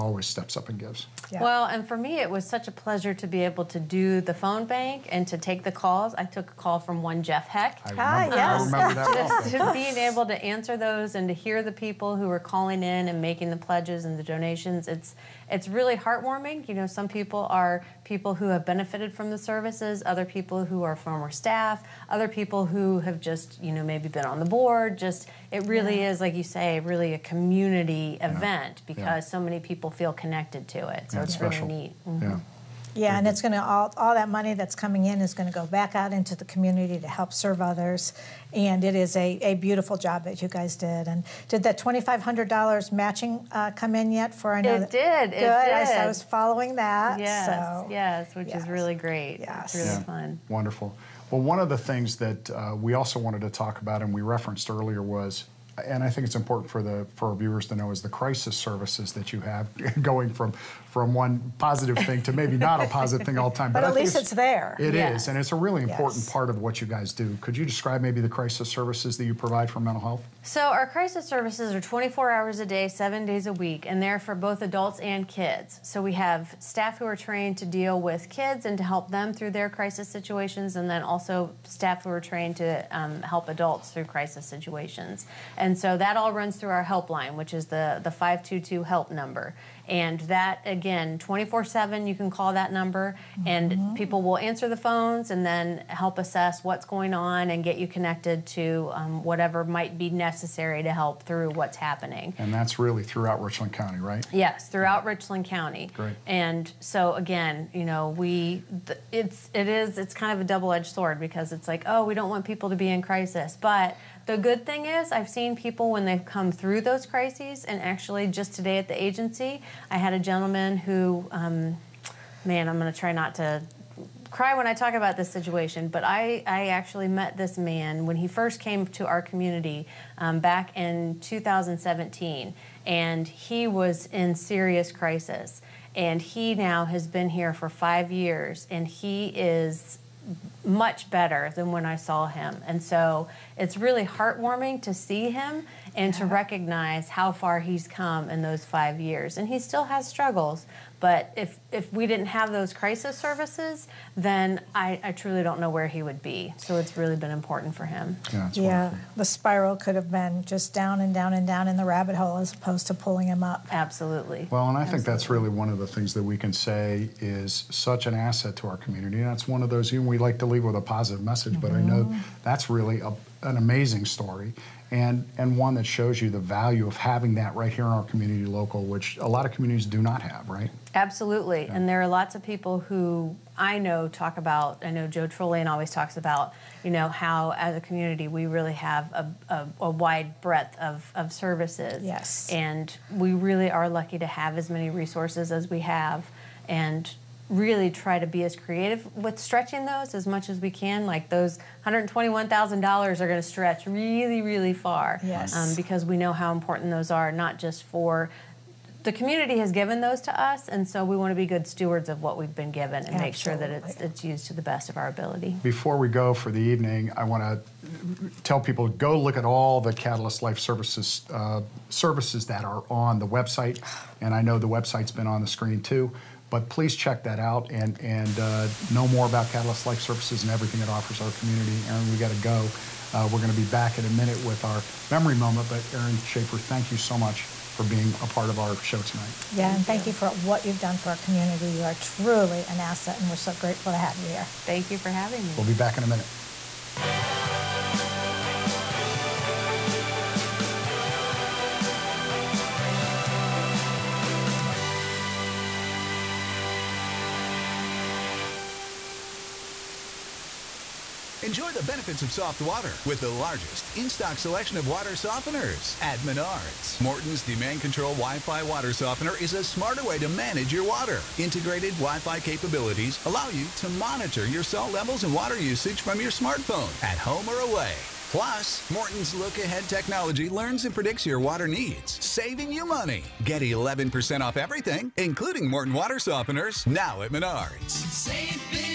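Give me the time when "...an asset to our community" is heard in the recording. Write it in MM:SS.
02:48.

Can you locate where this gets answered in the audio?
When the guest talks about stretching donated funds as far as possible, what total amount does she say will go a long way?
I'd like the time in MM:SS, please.
03:21.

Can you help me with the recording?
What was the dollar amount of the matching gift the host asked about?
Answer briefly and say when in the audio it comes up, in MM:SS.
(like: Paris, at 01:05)
$2,500, at 00:41.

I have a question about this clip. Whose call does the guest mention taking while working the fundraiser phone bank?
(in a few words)
Jeff Heck.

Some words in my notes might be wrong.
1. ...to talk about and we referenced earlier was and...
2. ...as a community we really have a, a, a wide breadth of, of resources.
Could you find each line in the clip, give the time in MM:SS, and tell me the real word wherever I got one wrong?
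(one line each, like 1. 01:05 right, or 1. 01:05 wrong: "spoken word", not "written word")
1. 00:53 right
2. 03:07 wrong: "services", not "resources".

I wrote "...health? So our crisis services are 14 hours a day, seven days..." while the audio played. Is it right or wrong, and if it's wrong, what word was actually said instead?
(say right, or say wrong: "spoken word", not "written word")
wrong: "24", not "14".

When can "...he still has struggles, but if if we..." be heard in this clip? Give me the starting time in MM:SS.
02:29.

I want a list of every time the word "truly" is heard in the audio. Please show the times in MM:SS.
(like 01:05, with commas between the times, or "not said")
02:35, 04:01.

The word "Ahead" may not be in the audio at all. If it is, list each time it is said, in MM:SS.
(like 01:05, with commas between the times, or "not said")
04:39.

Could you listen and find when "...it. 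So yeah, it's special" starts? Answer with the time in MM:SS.
00:30.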